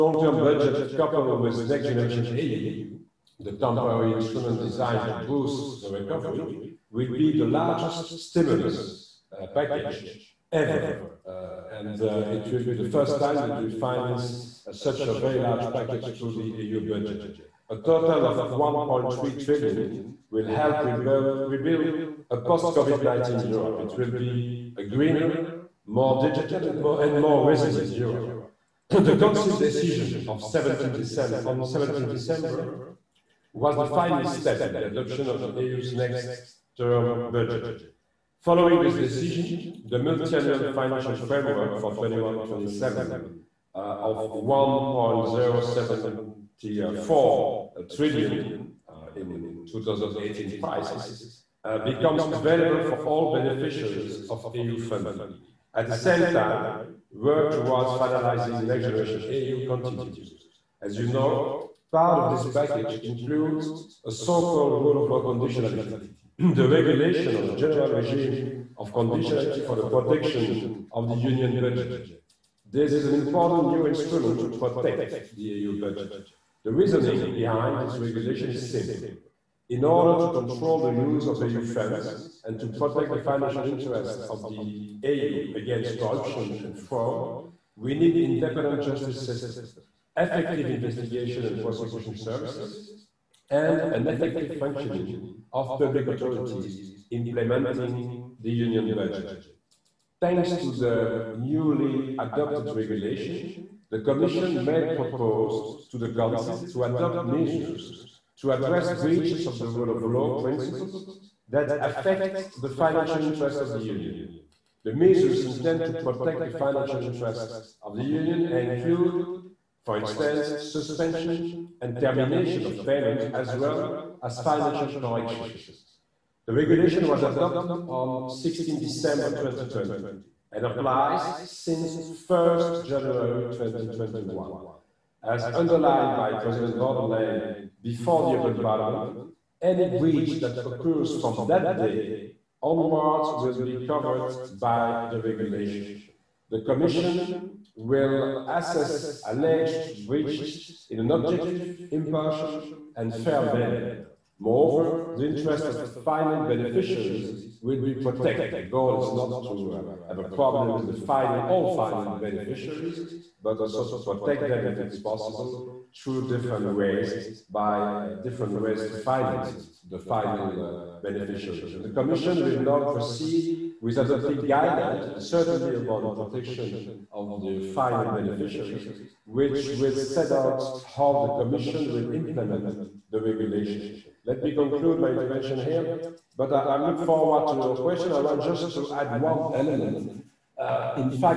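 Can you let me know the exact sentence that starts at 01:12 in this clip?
This is an important new instrument to protect the EU budget.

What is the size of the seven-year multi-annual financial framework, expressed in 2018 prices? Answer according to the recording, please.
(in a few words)
1.074 trillion.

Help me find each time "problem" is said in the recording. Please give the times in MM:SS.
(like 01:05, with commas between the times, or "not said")
02:40.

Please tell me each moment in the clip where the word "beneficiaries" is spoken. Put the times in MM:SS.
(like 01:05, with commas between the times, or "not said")
00:53, 02:36, 02:42, 02:51, 02:58.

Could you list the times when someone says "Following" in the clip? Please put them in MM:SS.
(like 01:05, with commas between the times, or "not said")
00:38.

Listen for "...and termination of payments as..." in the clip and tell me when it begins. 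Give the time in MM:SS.
02:01.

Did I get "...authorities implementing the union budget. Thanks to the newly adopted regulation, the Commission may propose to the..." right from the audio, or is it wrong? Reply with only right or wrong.
right.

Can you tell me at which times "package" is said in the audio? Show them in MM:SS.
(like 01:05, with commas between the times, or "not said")
00:09, 00:15, 01:02.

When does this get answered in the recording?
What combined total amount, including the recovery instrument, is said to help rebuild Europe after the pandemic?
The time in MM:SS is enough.
00:18.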